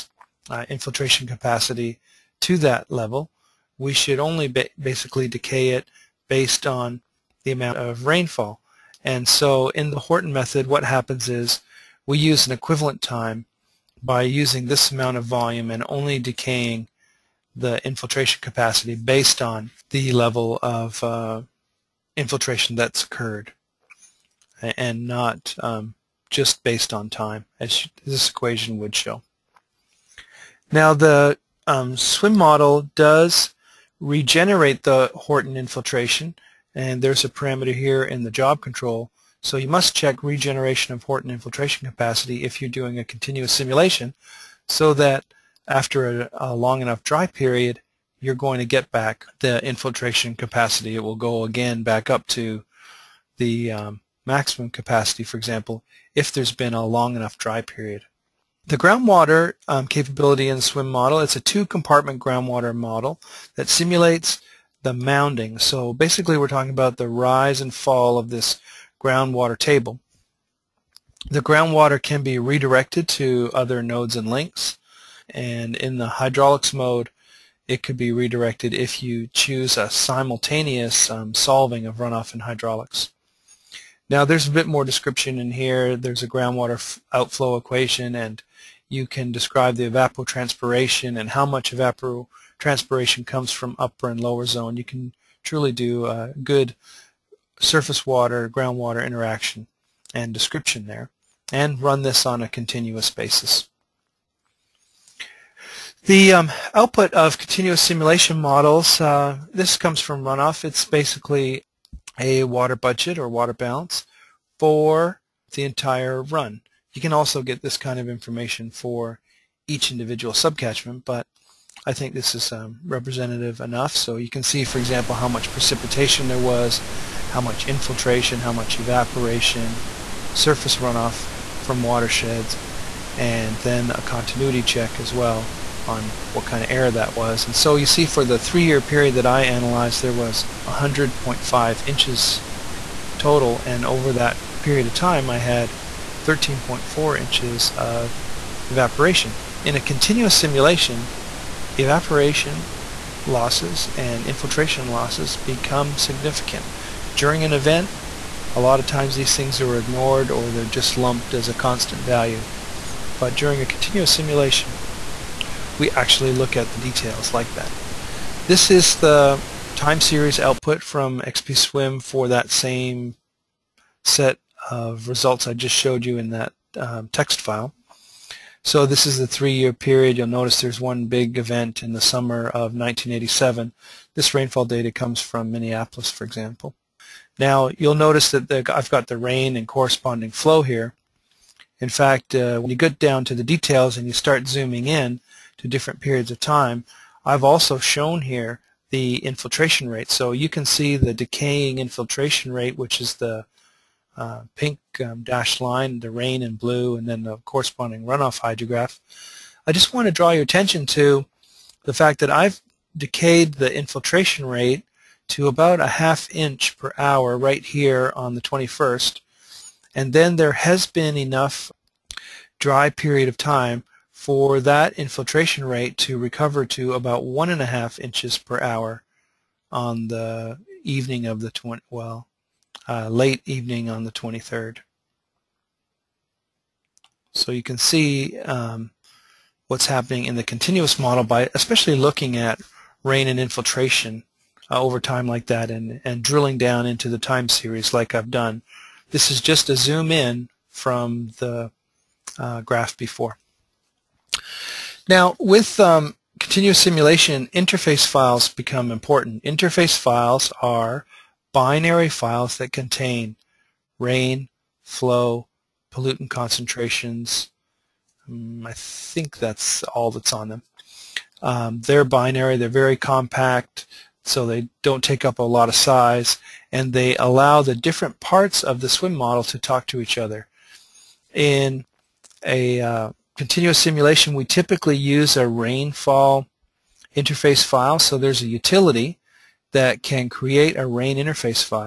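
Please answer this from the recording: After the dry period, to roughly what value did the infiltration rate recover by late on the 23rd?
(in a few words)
1.5 inches per hour.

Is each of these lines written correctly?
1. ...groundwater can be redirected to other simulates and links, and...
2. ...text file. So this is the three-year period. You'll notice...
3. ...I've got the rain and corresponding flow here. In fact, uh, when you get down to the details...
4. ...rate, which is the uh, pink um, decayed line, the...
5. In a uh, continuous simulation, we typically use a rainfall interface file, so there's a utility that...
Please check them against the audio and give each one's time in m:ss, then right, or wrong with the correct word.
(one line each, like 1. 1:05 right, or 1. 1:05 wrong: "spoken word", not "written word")
1. 1:11 wrong: "nodes", not "simulates"
2. 2:57 right
3. 3:08 right
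4. 3:22 wrong: "dashed", not "decayed"
5. 4:41 right.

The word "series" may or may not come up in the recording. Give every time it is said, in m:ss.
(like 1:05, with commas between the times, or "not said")
2:50, 4:07.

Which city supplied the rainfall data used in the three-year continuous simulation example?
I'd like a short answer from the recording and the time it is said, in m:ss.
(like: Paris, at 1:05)
Minneapolis, at 3:05.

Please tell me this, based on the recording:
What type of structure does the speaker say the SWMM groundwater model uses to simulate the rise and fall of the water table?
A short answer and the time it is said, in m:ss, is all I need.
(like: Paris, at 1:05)
two-compartment, at 1:01.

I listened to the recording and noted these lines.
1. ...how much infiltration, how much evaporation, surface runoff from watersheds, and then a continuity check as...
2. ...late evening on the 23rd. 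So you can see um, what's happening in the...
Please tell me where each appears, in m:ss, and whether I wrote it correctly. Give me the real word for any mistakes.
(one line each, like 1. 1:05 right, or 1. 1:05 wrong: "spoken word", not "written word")
1. 2:07 right
2. 3:53 right.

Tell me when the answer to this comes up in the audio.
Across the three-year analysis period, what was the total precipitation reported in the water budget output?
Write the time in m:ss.
2:20.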